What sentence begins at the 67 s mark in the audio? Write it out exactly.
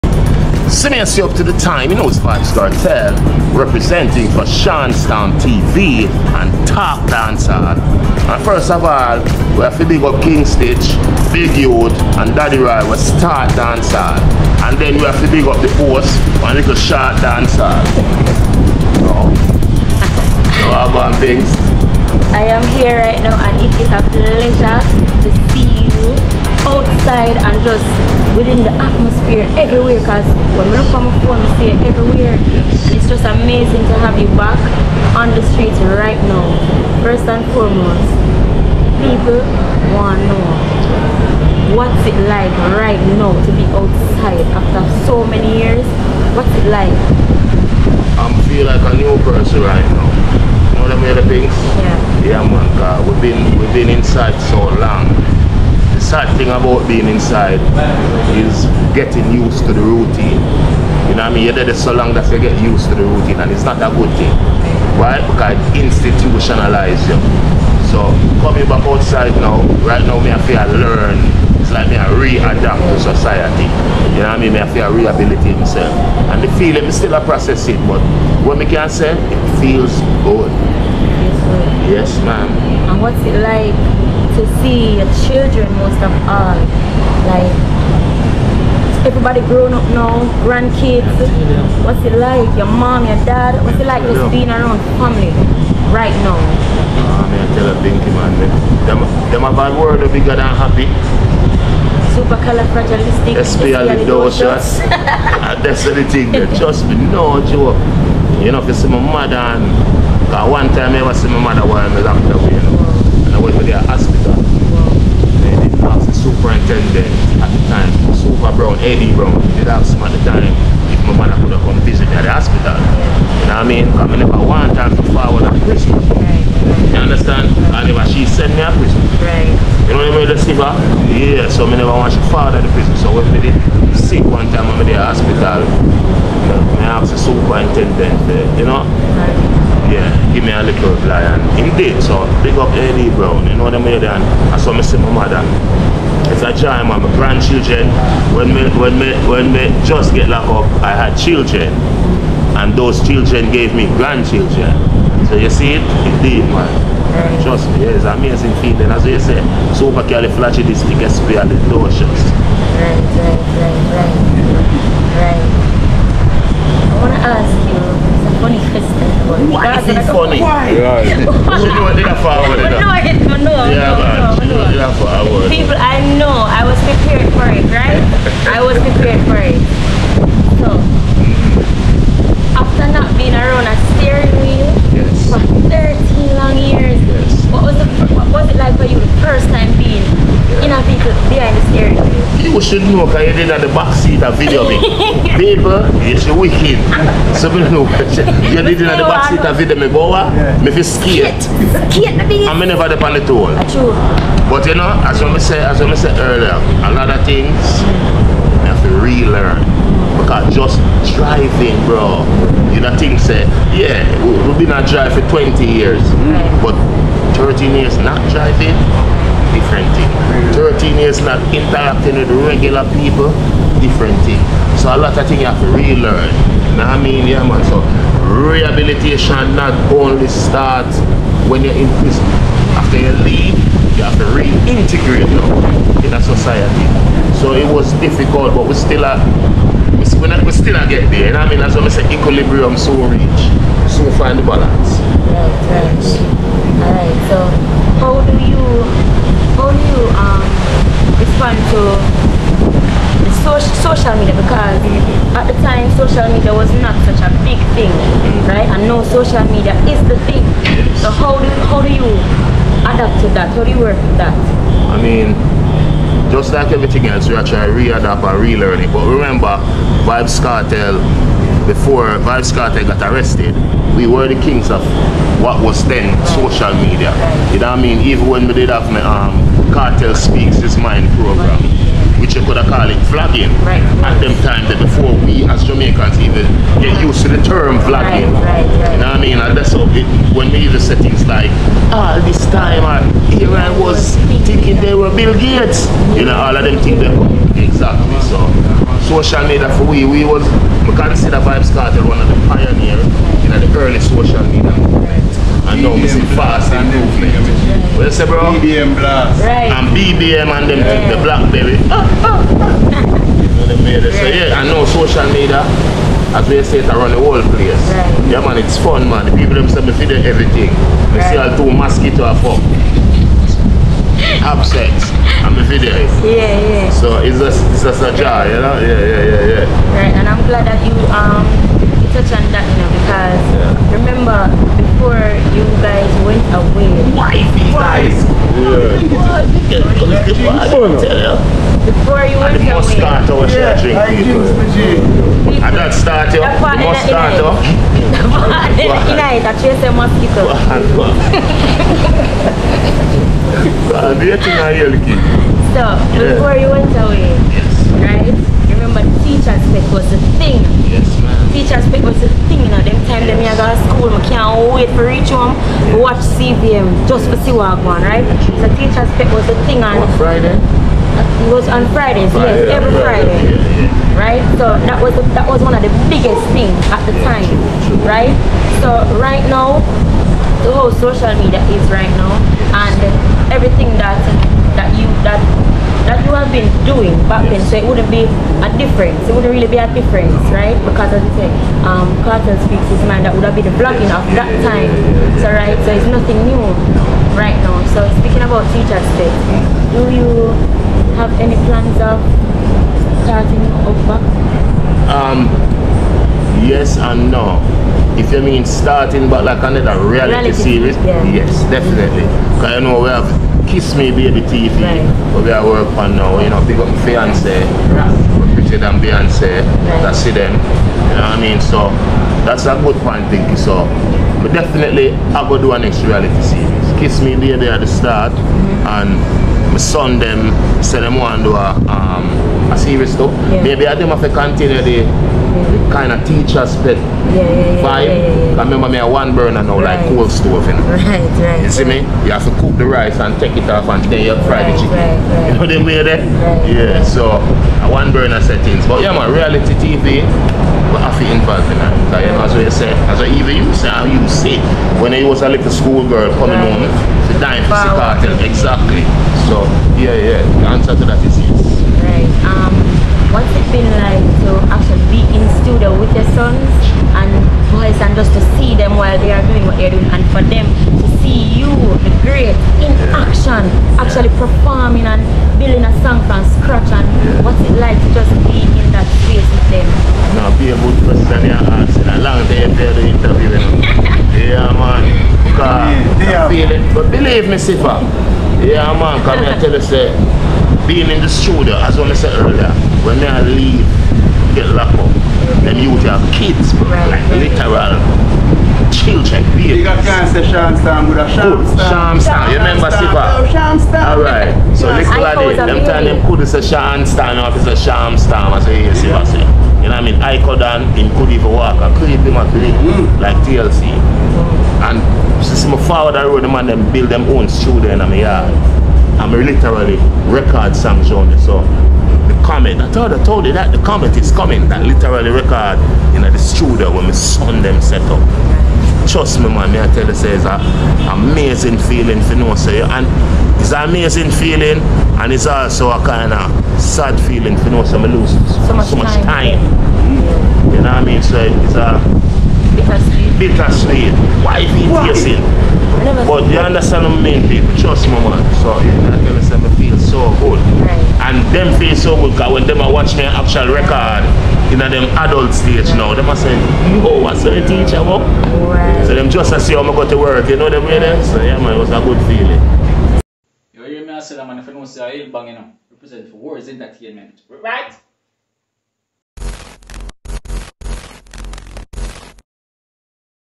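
So coming back outside now, right now me I feel learn.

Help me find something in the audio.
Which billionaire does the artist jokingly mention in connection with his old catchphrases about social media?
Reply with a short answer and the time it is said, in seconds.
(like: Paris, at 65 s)
Bill Gates, at 295 s.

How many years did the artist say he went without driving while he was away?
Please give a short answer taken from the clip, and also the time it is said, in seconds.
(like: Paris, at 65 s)
13, at 217 s.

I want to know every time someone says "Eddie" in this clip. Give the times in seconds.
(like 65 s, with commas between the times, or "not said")
118 s, 142 s.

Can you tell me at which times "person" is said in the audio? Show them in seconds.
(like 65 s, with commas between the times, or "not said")
49 s, 481 s.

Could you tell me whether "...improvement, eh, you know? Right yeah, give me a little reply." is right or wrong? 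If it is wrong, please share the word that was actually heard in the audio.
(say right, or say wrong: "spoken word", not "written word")
wrong: "superintendent", not "improvement".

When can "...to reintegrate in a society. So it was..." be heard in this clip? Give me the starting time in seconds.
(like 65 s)
234 s.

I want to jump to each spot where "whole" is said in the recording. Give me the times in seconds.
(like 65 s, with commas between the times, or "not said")
317 s, 380 s.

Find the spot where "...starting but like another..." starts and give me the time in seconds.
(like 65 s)
408 s.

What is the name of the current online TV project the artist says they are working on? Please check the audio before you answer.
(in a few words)
Kiss Me Baby TV.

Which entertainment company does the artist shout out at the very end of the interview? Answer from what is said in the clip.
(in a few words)
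Worryz Entertainment.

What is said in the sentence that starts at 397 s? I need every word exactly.
So speaking about future, space, do you have any plans of starting over?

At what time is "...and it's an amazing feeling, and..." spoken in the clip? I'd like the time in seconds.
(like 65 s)
532 s.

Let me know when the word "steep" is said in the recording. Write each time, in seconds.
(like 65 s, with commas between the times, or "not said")
not said.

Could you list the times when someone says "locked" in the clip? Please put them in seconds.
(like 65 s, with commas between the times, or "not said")
112 s, 150 s, 494 s.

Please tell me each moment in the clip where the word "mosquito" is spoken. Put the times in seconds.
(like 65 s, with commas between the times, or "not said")
321 s, 349 s.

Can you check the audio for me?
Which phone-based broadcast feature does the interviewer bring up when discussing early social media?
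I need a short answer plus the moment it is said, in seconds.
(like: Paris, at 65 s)
BBM Blast, at 308 s.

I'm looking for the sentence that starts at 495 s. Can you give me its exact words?
And you would have kids, bro.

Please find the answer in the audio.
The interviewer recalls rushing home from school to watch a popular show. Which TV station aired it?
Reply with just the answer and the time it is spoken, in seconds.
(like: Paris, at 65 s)
CVM, at 366 s.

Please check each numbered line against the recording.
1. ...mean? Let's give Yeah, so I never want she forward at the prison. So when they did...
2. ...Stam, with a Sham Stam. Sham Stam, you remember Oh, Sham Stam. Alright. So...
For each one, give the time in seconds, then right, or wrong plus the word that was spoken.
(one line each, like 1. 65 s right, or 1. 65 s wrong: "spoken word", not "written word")
1. 130 s right
2. 500 s right.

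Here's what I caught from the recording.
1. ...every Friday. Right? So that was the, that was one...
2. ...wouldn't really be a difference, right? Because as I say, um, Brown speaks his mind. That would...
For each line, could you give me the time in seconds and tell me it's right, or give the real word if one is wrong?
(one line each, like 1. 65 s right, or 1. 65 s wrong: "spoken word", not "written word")
1. 372 s right
2. 389 s wrong: "Kartel", not "Brown".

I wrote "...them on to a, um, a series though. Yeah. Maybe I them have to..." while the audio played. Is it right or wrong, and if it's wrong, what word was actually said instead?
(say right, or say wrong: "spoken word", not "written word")
right.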